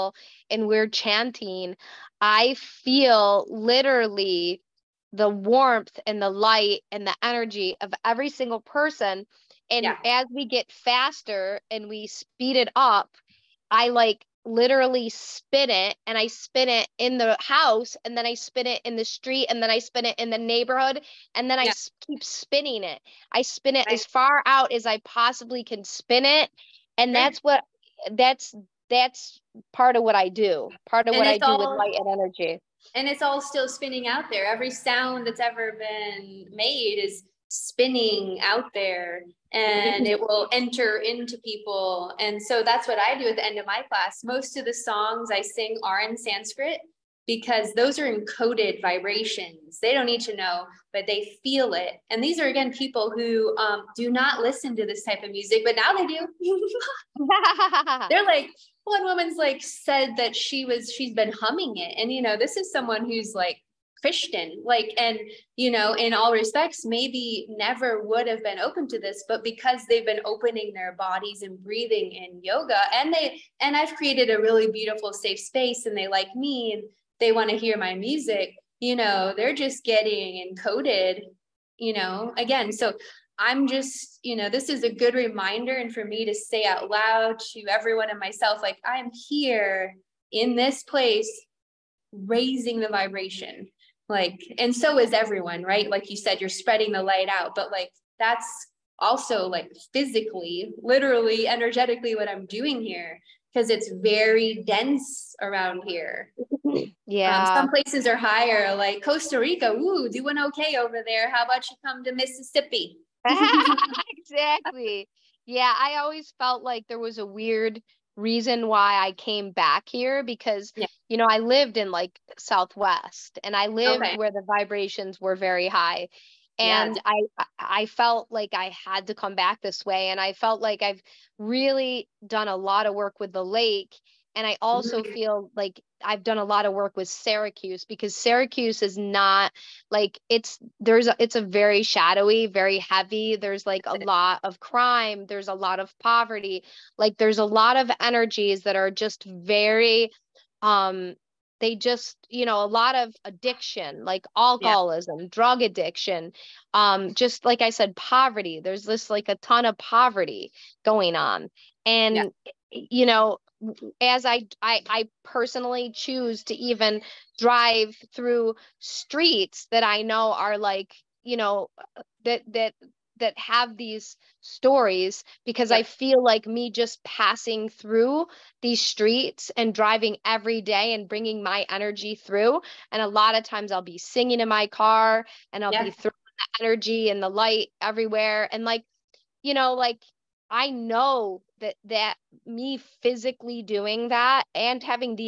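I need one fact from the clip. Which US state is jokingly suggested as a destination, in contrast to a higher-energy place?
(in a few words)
Mississippi.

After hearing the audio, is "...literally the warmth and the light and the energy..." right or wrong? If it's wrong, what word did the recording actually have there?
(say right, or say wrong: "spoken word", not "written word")
right.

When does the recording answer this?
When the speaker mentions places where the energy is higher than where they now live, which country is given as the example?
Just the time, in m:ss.
1:49.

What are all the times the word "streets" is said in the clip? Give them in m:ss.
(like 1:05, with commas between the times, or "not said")
0:19, 2:48, 2:58.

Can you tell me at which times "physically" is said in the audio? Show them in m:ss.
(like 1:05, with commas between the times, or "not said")
1:39, 3:13.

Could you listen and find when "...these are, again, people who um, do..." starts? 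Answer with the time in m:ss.
0:52.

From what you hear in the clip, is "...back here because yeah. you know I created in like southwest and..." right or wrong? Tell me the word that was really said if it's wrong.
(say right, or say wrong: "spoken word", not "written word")
wrong: "lived", not "created".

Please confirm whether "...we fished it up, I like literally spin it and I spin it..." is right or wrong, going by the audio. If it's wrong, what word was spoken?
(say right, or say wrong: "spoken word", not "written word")
wrong: "speed", not "fished".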